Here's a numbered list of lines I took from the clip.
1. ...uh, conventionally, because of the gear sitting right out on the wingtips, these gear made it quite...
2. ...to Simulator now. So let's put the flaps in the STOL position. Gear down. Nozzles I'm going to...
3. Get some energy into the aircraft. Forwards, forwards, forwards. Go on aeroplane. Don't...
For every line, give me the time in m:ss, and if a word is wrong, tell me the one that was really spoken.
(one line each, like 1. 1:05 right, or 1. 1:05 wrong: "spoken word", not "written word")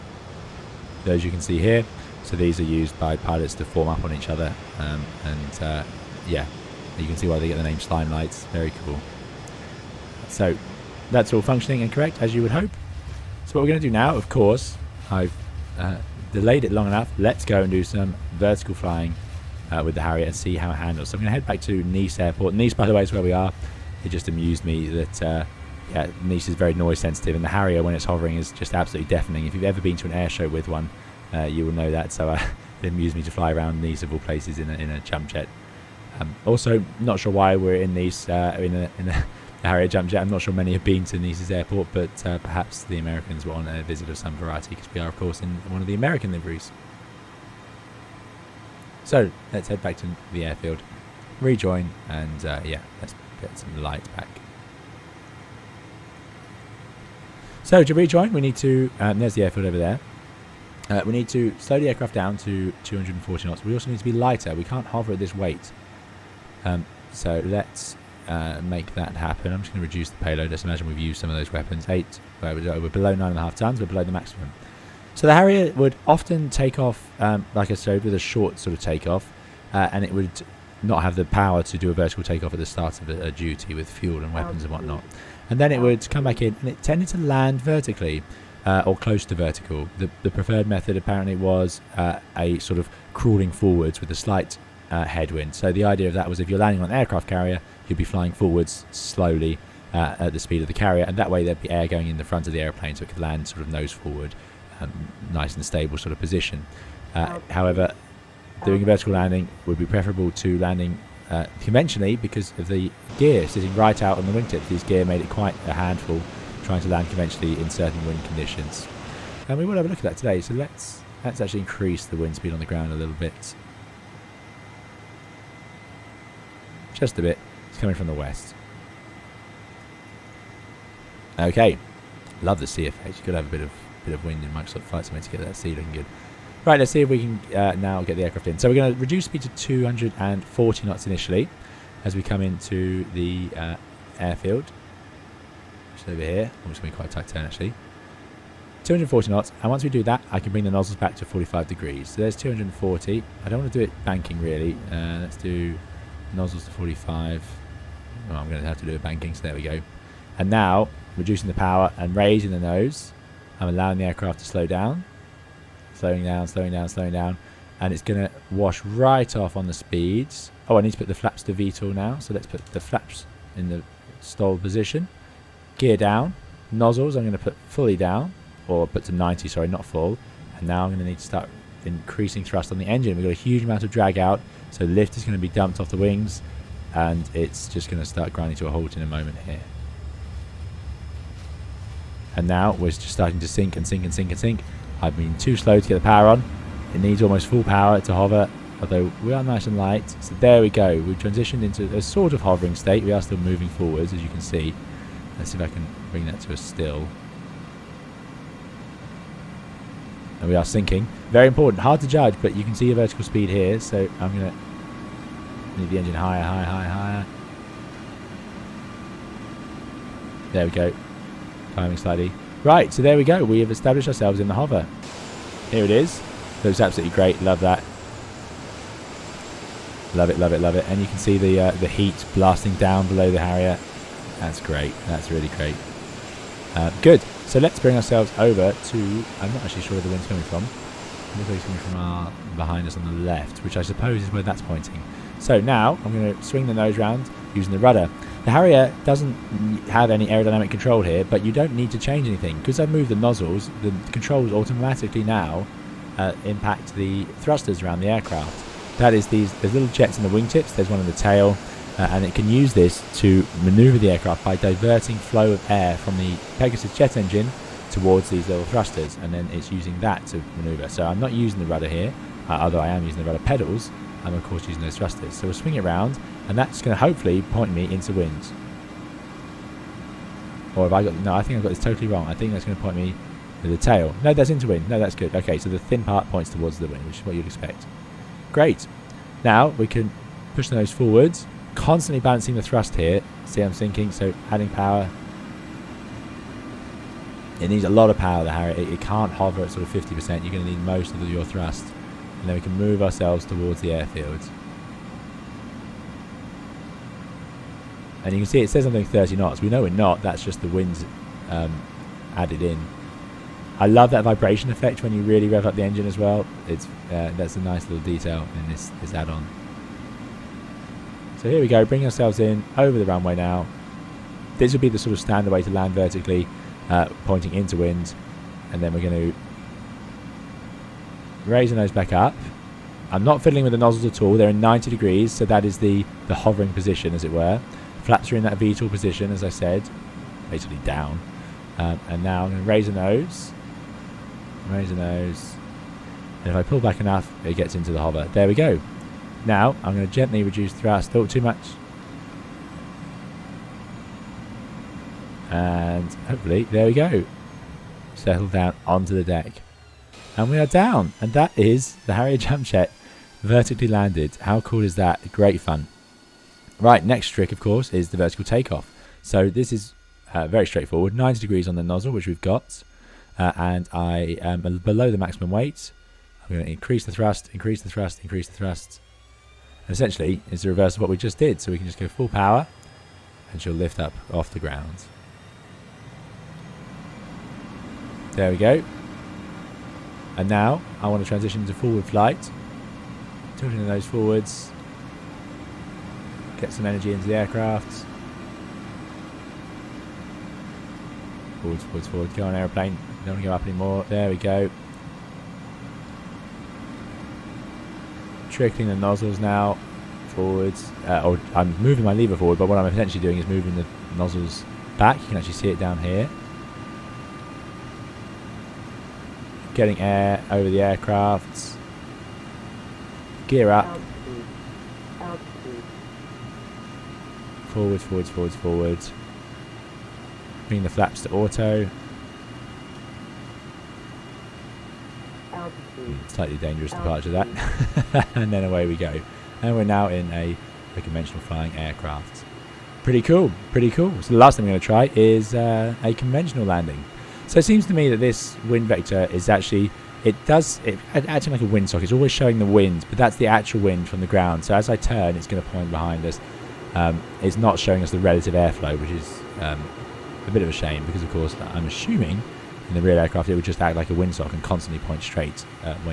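1. 1:51 right
2. 2:51 wrong: "VTOL", not "Simulator"
3. 6:36 right.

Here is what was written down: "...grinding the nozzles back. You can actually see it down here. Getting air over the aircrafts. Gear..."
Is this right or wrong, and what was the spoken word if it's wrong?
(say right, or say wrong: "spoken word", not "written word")
wrong: "moving", not "grinding".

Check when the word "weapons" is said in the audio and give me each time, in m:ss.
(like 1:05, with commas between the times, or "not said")
1:11, 1:24.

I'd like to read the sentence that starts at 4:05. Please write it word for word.
So now I'm going to swing the nose round using the rudder.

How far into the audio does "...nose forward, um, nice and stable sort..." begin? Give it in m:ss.
1:43.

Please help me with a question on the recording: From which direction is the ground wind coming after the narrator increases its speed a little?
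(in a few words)
west.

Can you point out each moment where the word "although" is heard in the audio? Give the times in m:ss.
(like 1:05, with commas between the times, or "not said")
3:18, 4:32.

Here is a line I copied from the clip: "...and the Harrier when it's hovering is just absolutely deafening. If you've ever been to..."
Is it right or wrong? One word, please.
right.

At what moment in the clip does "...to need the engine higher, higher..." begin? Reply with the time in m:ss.
3:34.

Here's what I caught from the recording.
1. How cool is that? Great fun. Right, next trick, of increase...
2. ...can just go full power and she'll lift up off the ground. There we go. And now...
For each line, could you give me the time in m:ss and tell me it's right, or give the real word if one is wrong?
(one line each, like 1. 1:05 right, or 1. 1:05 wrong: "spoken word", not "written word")
1. 6:04 wrong: "course", not "increase"
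2. 6:21 right.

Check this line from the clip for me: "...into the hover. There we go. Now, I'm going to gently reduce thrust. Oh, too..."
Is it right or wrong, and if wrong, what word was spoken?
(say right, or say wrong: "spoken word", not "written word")
right.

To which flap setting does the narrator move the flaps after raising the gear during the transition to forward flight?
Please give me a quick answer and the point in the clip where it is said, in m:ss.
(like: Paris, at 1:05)
auto, at 7:10.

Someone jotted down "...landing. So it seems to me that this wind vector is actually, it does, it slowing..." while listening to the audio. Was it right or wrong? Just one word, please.
wrong.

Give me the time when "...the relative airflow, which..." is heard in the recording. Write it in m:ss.
7:38.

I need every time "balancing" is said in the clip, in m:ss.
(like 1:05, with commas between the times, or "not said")
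4:52.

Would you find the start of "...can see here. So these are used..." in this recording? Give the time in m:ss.
0:01.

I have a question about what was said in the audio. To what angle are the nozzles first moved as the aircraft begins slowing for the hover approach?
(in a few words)
45 degrees.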